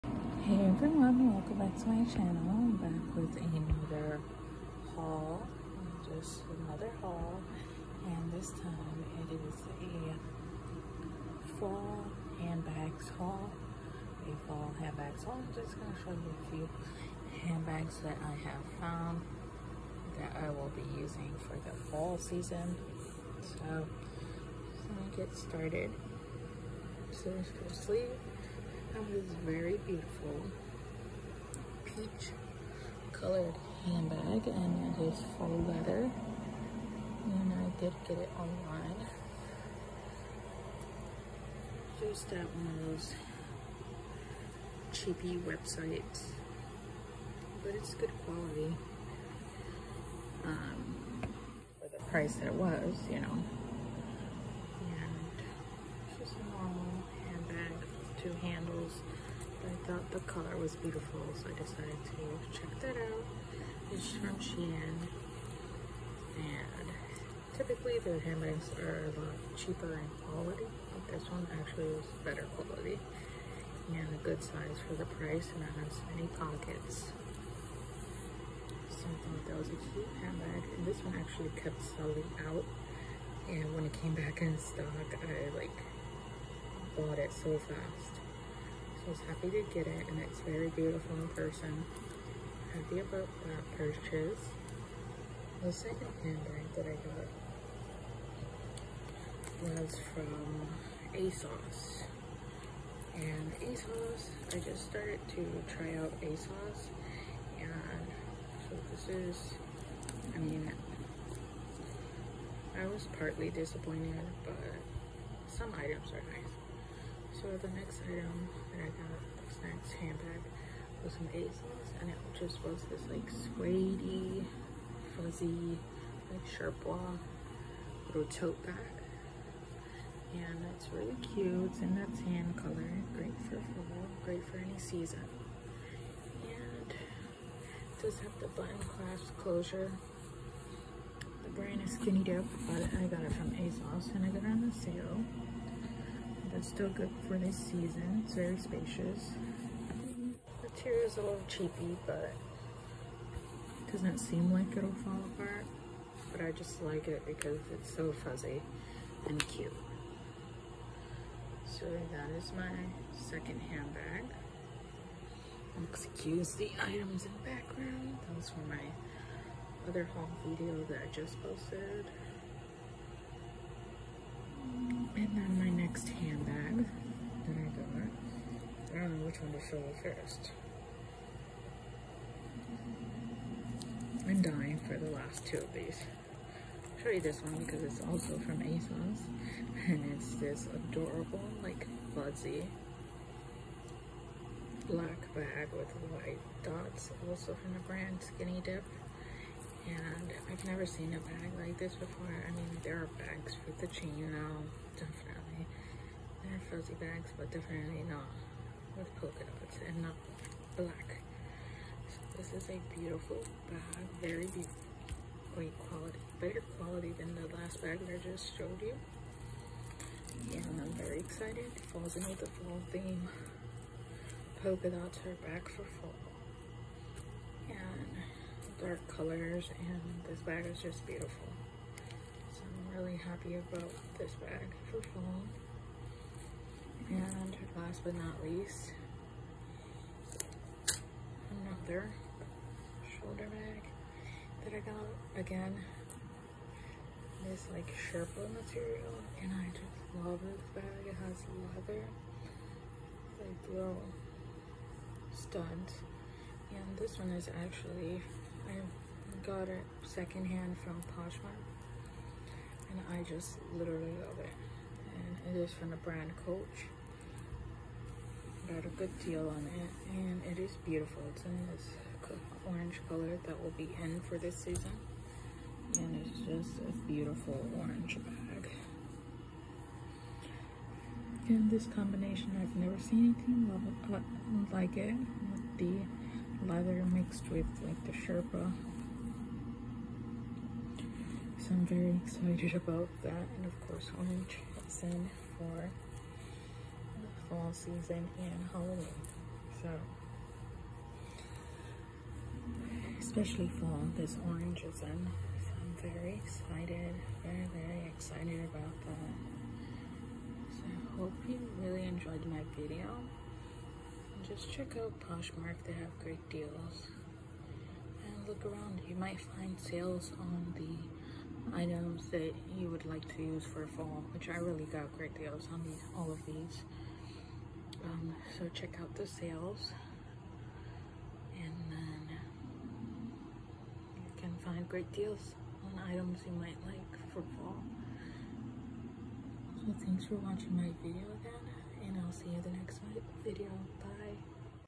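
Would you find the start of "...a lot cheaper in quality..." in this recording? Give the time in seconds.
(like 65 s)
69 s.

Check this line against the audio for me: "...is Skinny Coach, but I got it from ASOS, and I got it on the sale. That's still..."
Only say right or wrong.
wrong.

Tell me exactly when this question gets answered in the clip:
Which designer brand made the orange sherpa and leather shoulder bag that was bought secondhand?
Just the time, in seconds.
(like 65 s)
266 s.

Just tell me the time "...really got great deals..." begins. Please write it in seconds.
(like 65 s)
324 s.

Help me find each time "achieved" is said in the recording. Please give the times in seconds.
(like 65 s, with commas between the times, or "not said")
not said.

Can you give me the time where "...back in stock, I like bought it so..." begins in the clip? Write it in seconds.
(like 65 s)
84 s.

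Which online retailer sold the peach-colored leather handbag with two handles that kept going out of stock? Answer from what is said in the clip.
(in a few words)
Shein.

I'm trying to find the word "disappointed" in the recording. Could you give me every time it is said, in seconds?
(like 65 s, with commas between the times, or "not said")
113 s.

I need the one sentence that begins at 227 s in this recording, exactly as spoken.
And dark colors and this bag is just beautiful.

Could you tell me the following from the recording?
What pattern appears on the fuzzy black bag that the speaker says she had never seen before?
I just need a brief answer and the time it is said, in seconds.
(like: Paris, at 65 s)
white dots, at 196 s.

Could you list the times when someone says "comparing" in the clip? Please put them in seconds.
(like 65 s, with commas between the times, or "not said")
not said.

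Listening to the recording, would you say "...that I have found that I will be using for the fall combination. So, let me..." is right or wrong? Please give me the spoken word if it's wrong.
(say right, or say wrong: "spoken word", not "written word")
wrong: "season", not "combination".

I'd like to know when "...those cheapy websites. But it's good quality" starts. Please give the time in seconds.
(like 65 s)
42 s.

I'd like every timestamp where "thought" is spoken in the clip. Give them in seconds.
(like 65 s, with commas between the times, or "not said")
59 s, 79 s.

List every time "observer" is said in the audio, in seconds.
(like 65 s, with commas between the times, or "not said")
not said.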